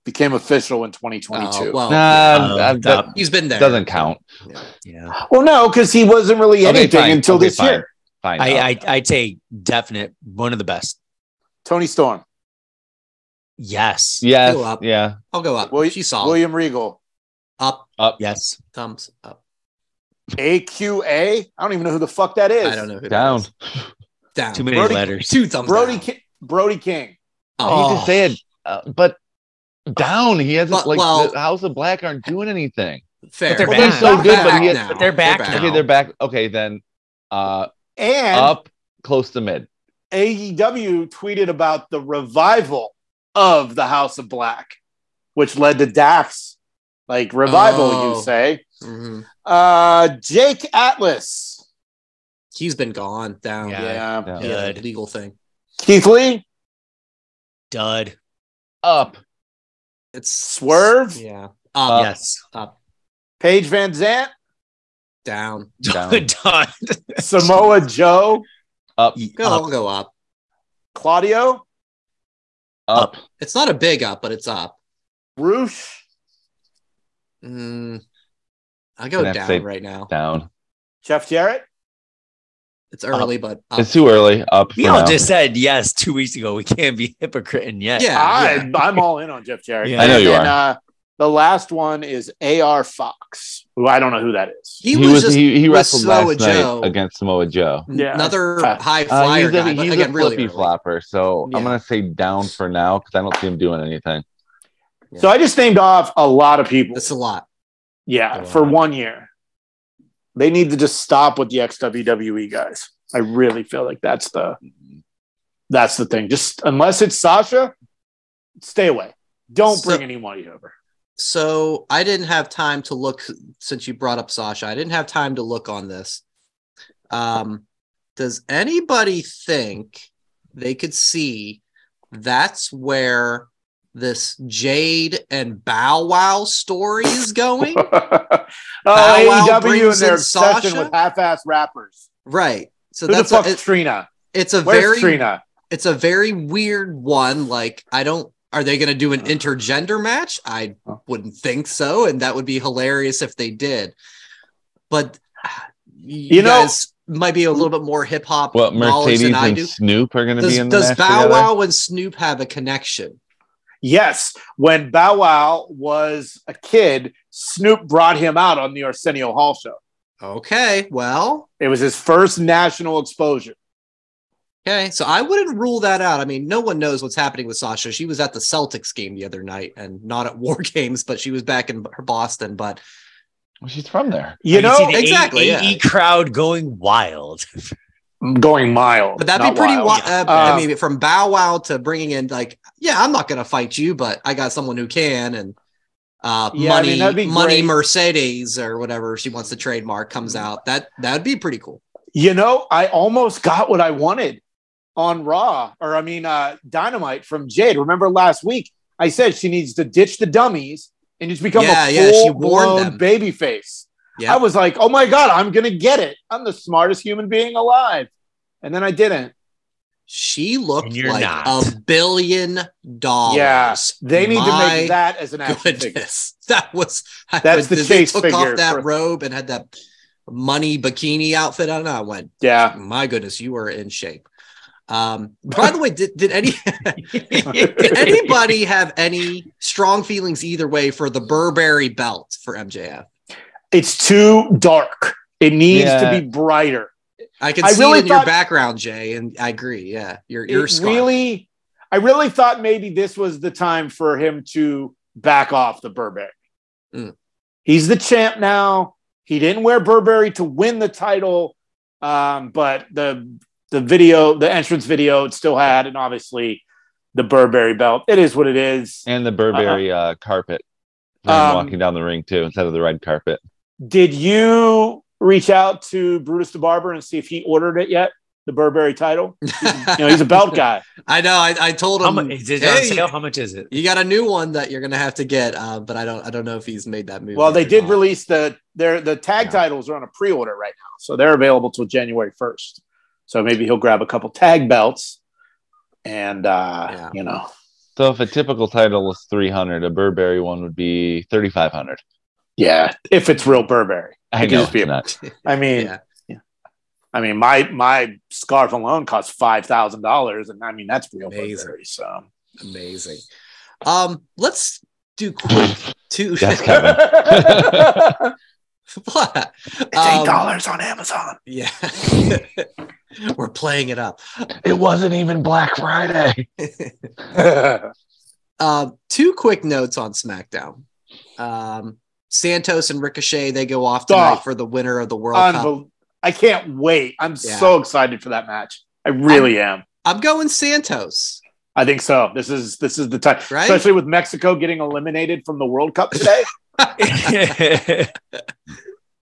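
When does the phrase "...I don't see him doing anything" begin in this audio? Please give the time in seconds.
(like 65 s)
103 s.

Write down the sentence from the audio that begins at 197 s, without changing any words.
Mercedes or whatever she wants to trademark comes mm.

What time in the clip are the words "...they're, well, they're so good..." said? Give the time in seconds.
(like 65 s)
33 s.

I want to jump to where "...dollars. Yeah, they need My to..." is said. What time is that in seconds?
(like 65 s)
222 s.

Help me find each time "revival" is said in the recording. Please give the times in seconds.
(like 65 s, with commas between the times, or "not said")
42 s, 47 s.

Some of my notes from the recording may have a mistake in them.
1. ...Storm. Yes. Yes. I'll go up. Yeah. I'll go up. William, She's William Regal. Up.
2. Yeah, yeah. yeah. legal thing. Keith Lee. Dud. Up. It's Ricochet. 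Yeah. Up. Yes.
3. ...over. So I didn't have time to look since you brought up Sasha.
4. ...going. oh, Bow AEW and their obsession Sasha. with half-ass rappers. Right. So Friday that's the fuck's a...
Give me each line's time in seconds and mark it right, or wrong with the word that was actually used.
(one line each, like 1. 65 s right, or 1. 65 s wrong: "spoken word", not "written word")
1. 11 s right
2. 53 s wrong: "Swerve", not "Ricochet"
3. 120 s right
4. 137 s wrong: "Who", not "Friday".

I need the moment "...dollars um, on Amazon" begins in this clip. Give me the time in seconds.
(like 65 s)
320 s.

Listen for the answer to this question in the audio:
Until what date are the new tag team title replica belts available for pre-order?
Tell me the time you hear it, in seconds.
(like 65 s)
291 s.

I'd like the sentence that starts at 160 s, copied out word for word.
The does Bow Wow and Snoop have a connection?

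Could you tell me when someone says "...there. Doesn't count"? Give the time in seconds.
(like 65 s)
3 s.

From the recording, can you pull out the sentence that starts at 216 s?
I'm the smartest human being alive.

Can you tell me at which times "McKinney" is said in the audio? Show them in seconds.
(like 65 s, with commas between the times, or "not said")
not said.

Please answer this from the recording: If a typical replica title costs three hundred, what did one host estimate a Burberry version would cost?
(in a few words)
3500.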